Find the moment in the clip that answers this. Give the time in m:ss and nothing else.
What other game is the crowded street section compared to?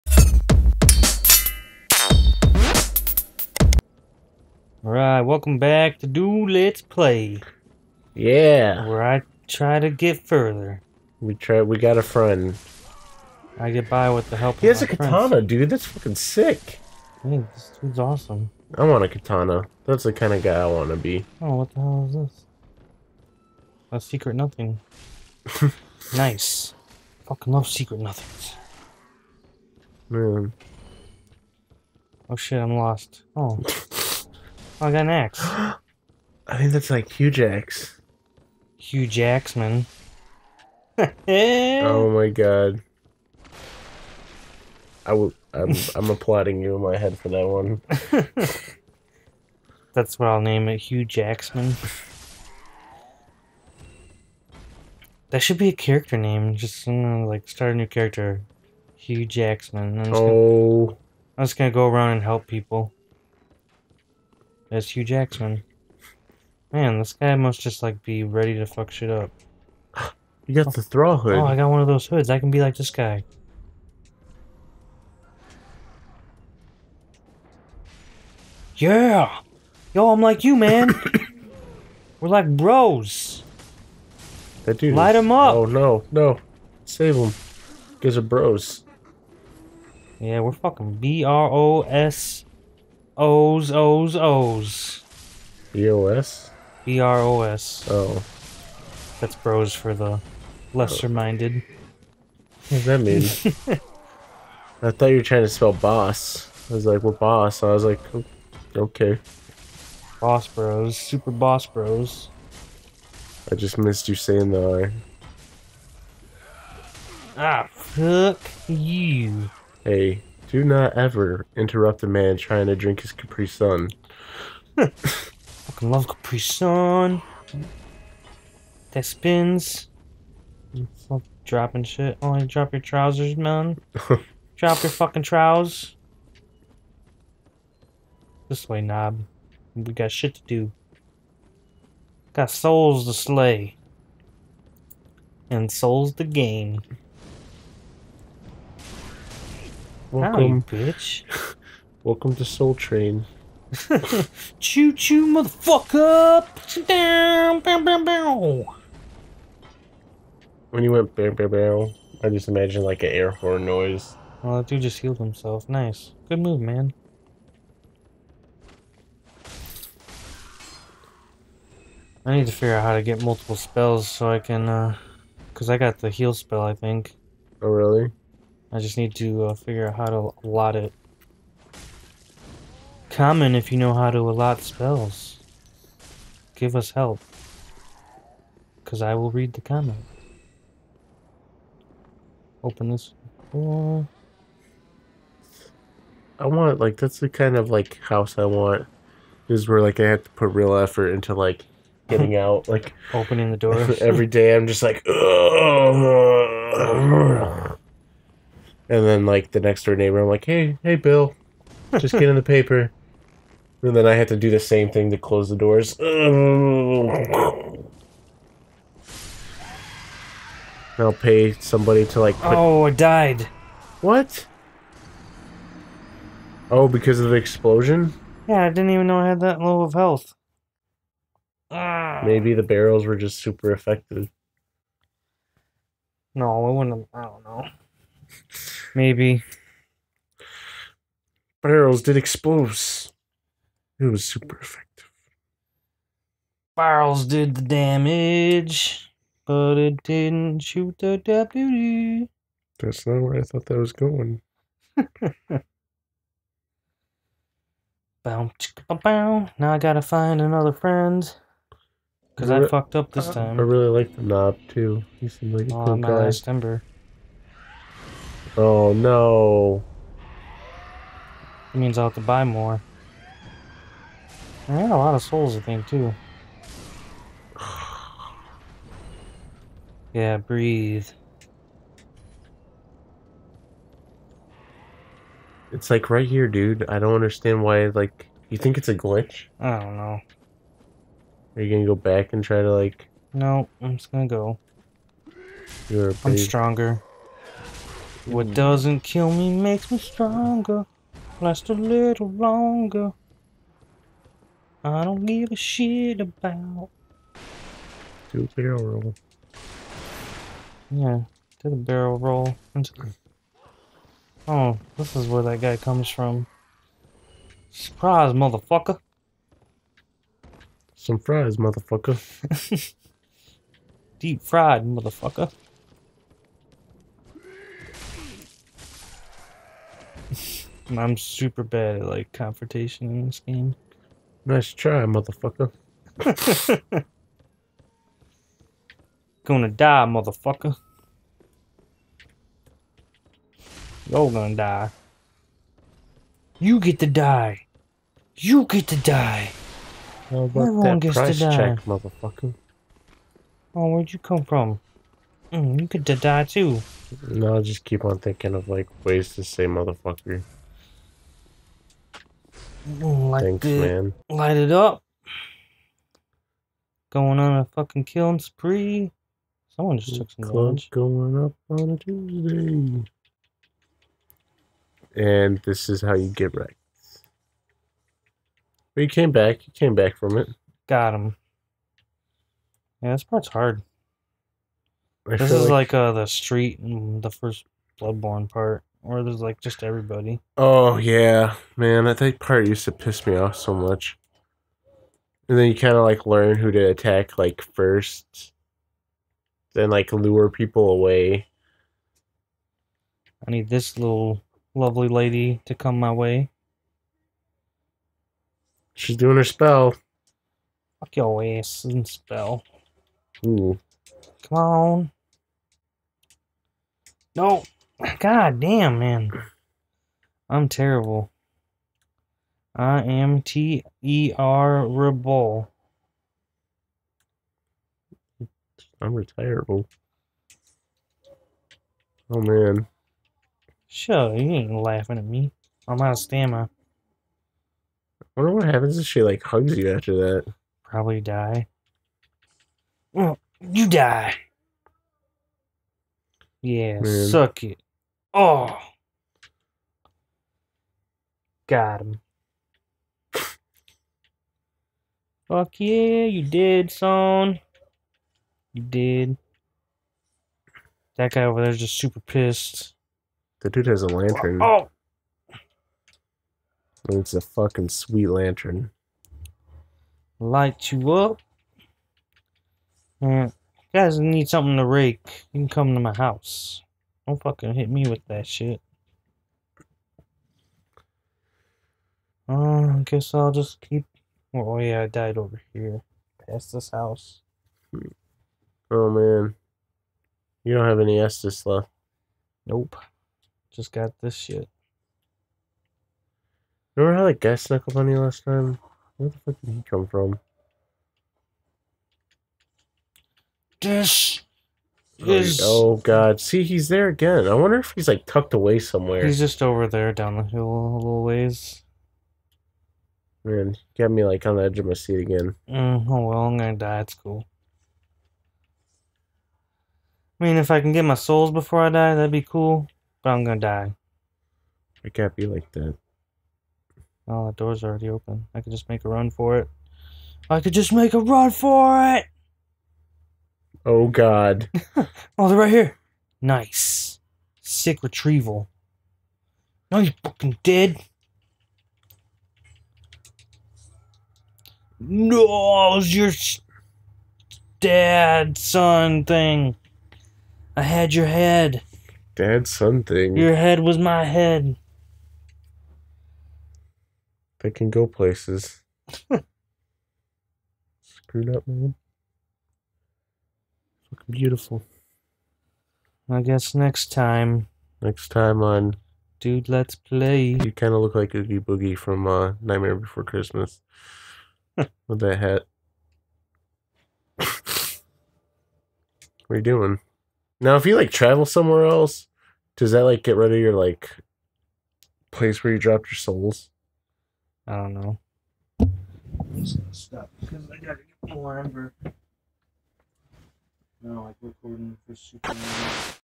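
6:27.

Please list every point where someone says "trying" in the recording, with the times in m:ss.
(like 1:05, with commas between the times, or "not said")
1:45, 2:02.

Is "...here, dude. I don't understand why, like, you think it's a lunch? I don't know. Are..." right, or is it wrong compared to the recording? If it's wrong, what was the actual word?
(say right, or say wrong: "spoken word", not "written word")
wrong: "glitch", not "lunch".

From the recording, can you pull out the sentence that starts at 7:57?
Don't fucking hit me with that shit.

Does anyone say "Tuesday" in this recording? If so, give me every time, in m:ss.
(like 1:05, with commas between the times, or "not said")
6:11.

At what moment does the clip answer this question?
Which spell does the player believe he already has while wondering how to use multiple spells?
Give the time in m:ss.
2:56.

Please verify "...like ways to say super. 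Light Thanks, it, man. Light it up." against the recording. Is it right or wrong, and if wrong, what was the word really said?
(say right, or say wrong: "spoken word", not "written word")
wrong: "motherfucker", not "super".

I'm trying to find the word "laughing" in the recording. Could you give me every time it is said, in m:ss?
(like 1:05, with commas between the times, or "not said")
7:14.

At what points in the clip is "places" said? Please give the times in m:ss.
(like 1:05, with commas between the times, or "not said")
9:18, 9:45.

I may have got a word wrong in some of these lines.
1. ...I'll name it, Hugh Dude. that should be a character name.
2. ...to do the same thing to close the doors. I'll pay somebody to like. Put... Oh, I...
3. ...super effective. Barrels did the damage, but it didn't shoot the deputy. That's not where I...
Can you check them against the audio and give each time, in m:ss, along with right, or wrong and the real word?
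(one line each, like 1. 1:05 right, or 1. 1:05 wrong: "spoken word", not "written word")
1. 0:50 wrong: "Jacksman", not "Dude"
2. 3:34 right
3. 4:04 right.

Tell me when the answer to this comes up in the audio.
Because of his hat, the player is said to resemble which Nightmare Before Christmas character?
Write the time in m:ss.
9:31.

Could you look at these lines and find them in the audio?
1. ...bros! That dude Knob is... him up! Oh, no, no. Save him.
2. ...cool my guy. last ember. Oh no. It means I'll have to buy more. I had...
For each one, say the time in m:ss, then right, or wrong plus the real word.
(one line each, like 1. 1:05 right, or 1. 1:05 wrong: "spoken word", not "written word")
1. 1:22 wrong: "Light", not "Knob"
2. 4:25 right.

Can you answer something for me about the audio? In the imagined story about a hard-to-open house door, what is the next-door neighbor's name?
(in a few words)
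Bill.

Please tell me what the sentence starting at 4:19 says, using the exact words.
Now I gotta find another friend.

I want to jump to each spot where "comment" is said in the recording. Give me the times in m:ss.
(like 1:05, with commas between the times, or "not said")
3:03, 3:09.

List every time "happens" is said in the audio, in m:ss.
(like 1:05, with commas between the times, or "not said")
7:18.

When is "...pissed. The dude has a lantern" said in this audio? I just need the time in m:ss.
7:42.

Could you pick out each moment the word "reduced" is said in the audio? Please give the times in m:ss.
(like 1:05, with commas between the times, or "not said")
not said.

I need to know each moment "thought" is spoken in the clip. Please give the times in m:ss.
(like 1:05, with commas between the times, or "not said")
1:44, 4:13.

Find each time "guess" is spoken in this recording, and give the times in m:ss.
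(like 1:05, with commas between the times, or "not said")
8:03, 9:26.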